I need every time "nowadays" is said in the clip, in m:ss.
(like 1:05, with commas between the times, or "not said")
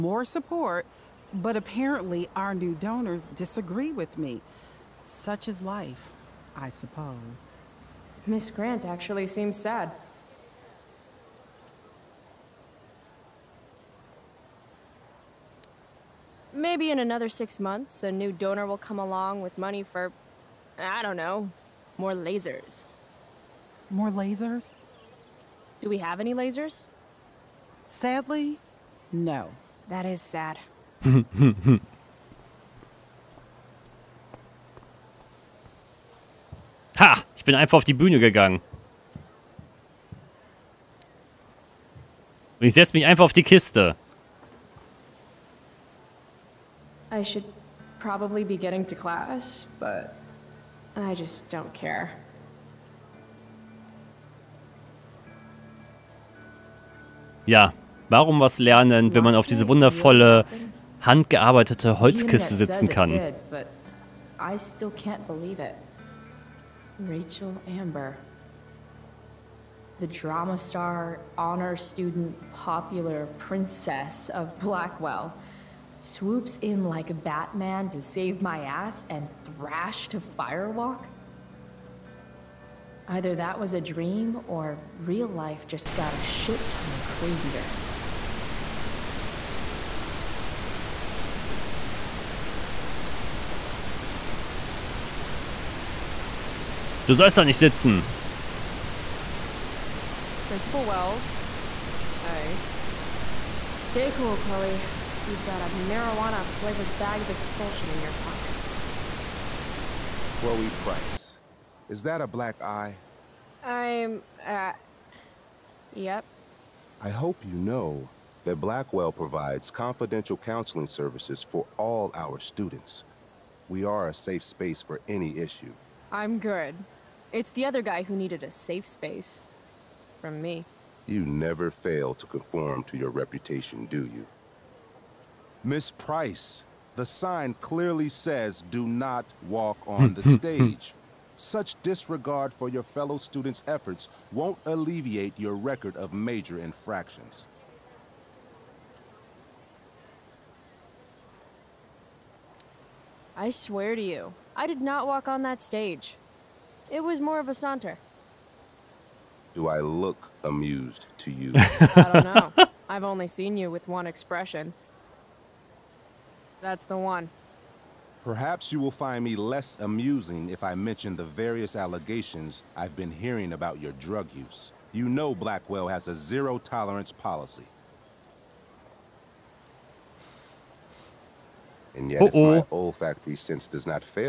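not said.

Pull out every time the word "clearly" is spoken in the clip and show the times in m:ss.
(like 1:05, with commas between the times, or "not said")
2:17.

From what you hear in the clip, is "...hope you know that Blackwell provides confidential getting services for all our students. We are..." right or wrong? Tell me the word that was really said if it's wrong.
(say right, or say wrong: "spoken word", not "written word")
wrong: "counseling", not "getting".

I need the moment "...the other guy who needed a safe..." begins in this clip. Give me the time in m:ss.
2:07.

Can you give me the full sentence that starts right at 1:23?
Either that was a dream or real life just got a shit ton crazier.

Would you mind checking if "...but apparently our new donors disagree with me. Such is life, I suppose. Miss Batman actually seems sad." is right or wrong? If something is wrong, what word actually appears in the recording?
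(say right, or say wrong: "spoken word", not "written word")
wrong: "Grant", not "Batman".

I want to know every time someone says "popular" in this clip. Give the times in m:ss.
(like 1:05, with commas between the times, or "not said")
1:12.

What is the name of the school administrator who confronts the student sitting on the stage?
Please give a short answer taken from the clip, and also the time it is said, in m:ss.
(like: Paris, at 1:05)
Principal Wells, at 1:40.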